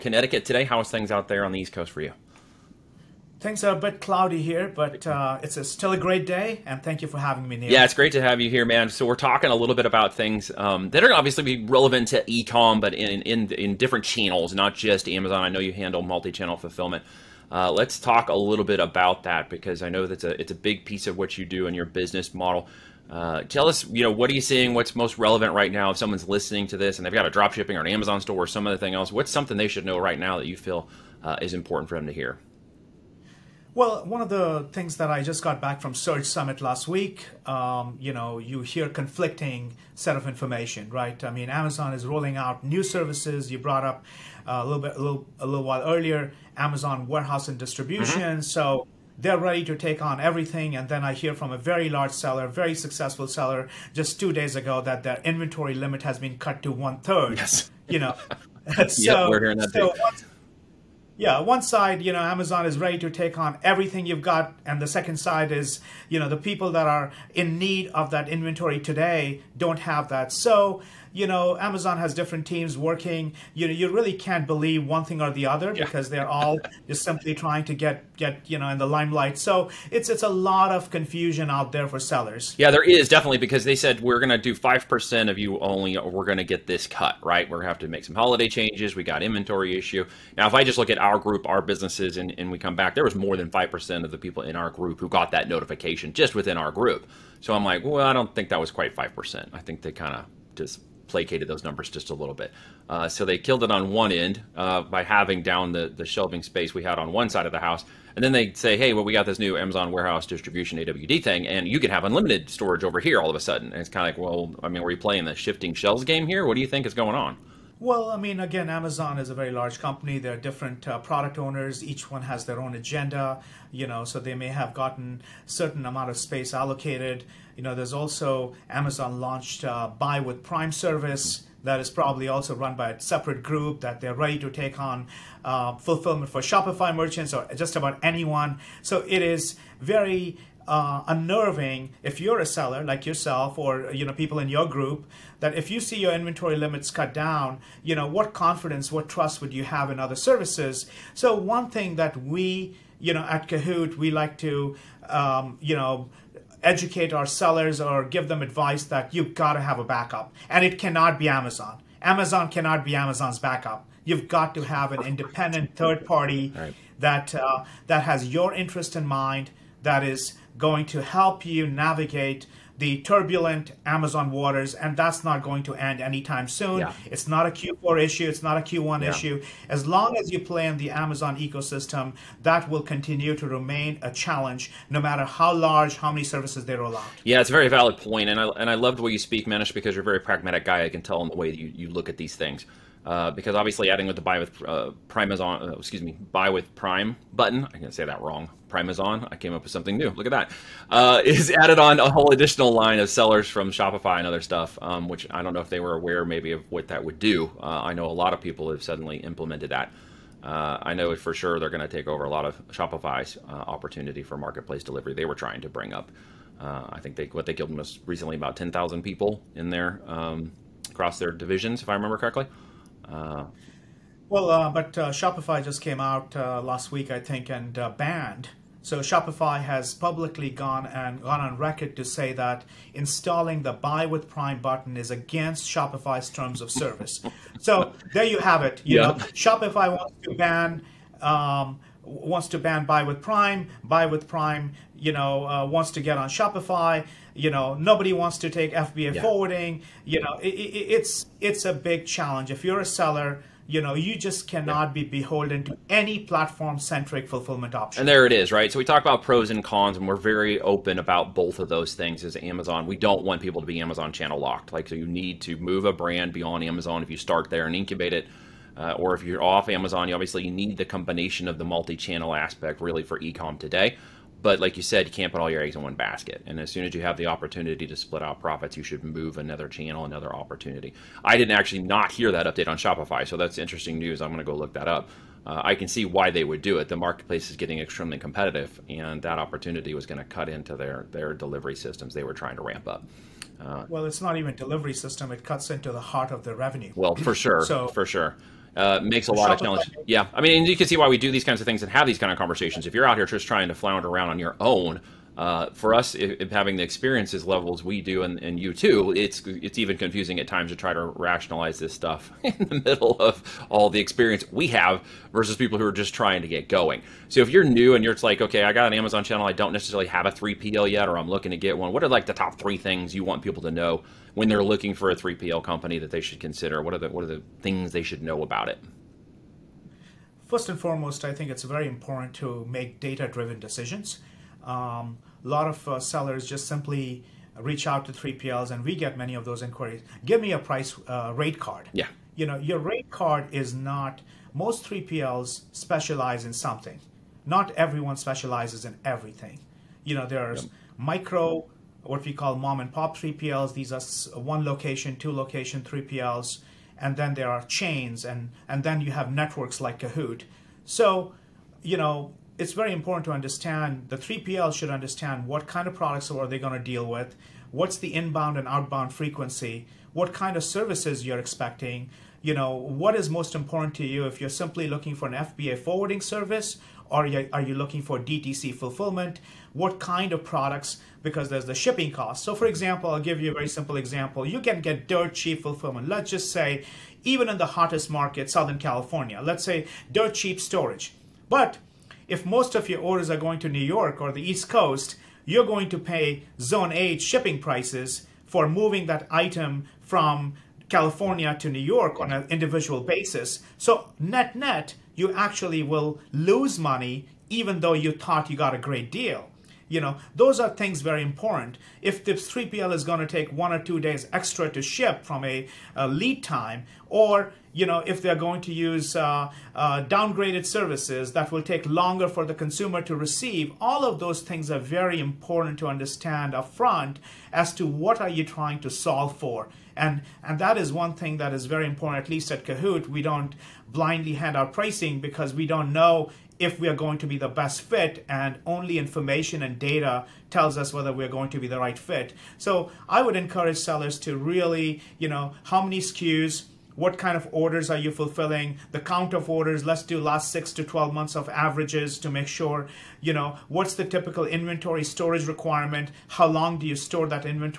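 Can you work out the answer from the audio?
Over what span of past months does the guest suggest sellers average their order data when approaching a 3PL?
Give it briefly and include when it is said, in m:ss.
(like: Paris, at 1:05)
6 to 12 months, at 7:30.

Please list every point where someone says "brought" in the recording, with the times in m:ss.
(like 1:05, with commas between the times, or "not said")
0:43.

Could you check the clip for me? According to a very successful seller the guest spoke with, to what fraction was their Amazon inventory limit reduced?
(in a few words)
One third.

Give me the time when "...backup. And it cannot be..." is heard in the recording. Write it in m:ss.
2:39.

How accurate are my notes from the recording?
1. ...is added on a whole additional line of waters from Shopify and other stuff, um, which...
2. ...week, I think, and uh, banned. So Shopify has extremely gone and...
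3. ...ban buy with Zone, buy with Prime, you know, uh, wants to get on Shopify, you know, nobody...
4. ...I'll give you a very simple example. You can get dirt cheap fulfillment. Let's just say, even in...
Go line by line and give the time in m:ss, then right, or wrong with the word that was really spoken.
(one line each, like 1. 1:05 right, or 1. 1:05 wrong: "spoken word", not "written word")
1. 3:21 wrong: "sellers", not "waters"
2. 3:46 wrong: "publicly", not "extremely"
3. 4:02 wrong: "Prime", not "Zone"
4. 6:23 right.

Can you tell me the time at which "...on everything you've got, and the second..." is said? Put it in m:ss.
1:03.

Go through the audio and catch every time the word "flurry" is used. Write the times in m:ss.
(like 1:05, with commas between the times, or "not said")
not said.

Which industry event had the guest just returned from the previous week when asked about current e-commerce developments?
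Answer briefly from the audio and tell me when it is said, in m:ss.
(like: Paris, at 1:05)
Search Summit, at 0:35.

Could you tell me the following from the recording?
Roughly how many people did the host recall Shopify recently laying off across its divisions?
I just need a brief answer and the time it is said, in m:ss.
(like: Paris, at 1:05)
10,000, at 3:38.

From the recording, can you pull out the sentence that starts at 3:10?
I can tell in the way that you, you look at these things.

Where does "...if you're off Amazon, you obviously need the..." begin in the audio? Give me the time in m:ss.
4:29.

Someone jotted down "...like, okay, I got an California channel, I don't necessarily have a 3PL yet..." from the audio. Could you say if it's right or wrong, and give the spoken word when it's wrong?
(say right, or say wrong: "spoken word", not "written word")
wrong: "Amazon", not "California".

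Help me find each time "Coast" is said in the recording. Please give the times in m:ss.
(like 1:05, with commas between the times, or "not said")
0:01, 6:34.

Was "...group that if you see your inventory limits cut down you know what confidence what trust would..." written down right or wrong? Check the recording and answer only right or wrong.
right.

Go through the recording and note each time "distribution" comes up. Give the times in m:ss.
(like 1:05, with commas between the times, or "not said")
0:47, 1:50.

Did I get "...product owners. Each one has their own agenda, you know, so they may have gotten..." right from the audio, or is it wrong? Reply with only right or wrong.
right.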